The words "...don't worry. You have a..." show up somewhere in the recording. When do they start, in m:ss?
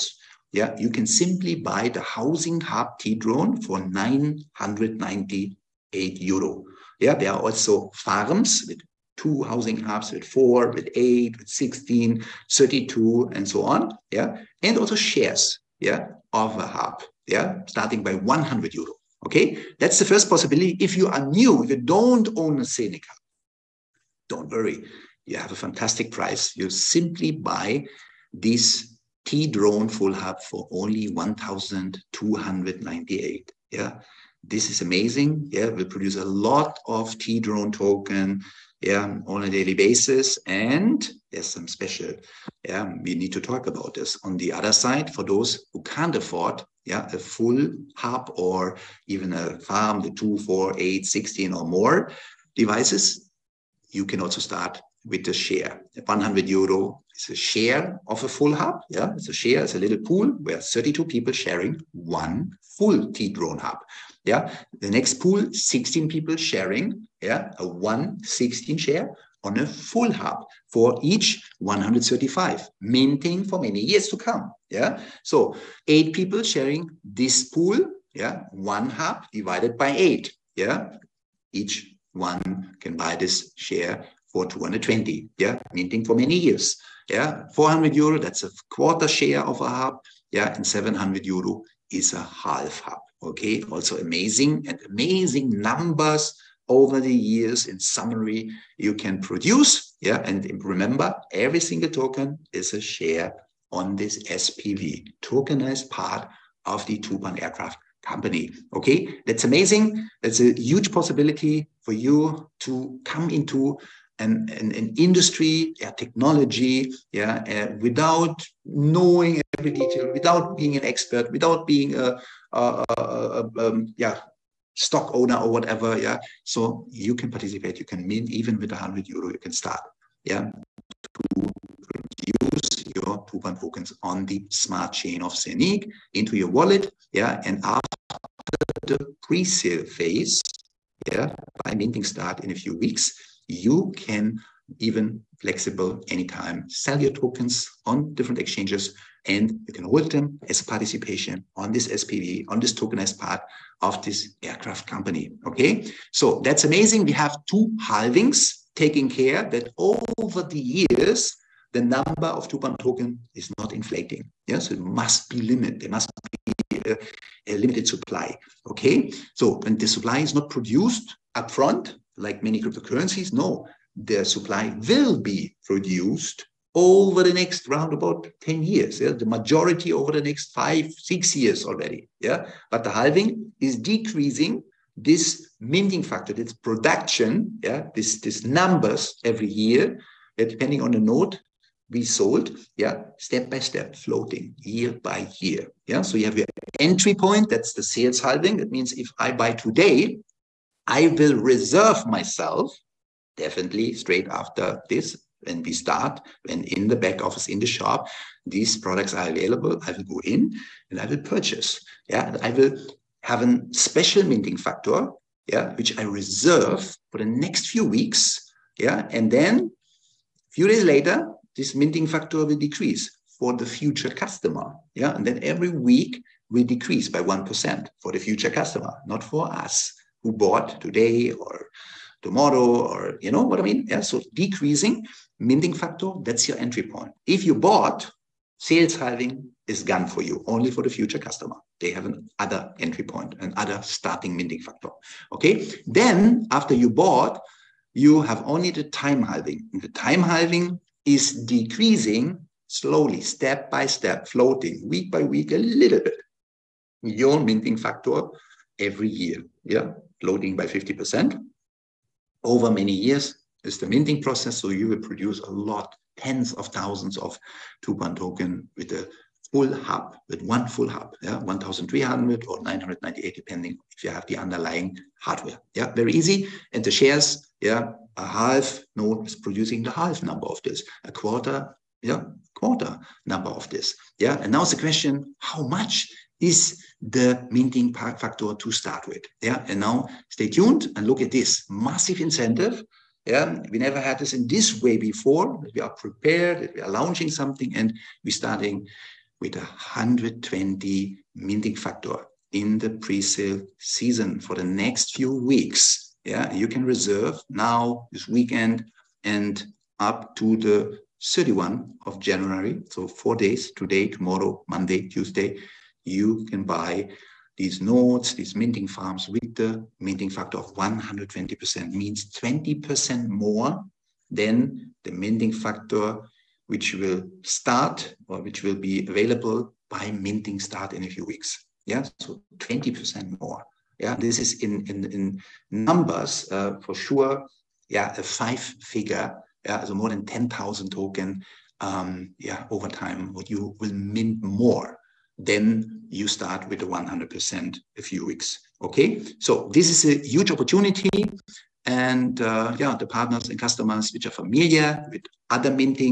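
0:24.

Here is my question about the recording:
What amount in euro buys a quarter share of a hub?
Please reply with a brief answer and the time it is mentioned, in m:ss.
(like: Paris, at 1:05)
400 euro, at 1:27.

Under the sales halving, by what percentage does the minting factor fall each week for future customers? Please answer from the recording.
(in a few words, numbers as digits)
1%.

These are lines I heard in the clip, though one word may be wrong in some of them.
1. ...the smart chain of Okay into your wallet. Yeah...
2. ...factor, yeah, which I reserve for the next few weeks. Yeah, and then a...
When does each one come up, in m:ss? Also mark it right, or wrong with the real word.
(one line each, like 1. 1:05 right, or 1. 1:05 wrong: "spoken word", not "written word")
1. 2:14 wrong: "ZENIQ", not "Okay"
2. 3:34 right.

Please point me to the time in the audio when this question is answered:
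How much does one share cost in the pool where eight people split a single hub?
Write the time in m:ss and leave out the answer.
1:24.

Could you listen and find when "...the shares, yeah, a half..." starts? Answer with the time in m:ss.
4:36.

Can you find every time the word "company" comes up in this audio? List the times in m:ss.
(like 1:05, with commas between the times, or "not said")
1:48, 2:34.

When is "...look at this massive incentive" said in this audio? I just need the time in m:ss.
4:51.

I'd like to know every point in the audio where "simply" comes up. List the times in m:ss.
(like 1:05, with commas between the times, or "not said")
0:01, 0:26.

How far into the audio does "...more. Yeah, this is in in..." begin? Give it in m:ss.
5:33.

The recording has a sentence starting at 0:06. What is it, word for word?
Yeah, there are also farms with two housing hubs with four, with eight, with 16, 32, and so on.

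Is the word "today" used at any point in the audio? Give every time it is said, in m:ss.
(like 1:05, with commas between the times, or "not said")
3:19, 3:50, 5:13.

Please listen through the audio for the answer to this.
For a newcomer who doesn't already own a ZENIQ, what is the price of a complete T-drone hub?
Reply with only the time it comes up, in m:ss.
0:31.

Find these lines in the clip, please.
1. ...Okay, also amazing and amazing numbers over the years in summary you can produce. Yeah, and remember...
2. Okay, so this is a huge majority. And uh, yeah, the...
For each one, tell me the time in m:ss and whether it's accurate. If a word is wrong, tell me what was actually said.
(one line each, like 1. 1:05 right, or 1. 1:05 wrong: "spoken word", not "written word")
1. 1:33 right
2. 5:48 wrong: "opportunity", not "majority".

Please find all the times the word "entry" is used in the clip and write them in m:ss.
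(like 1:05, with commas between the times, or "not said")
3:16, 3:56, 4:02.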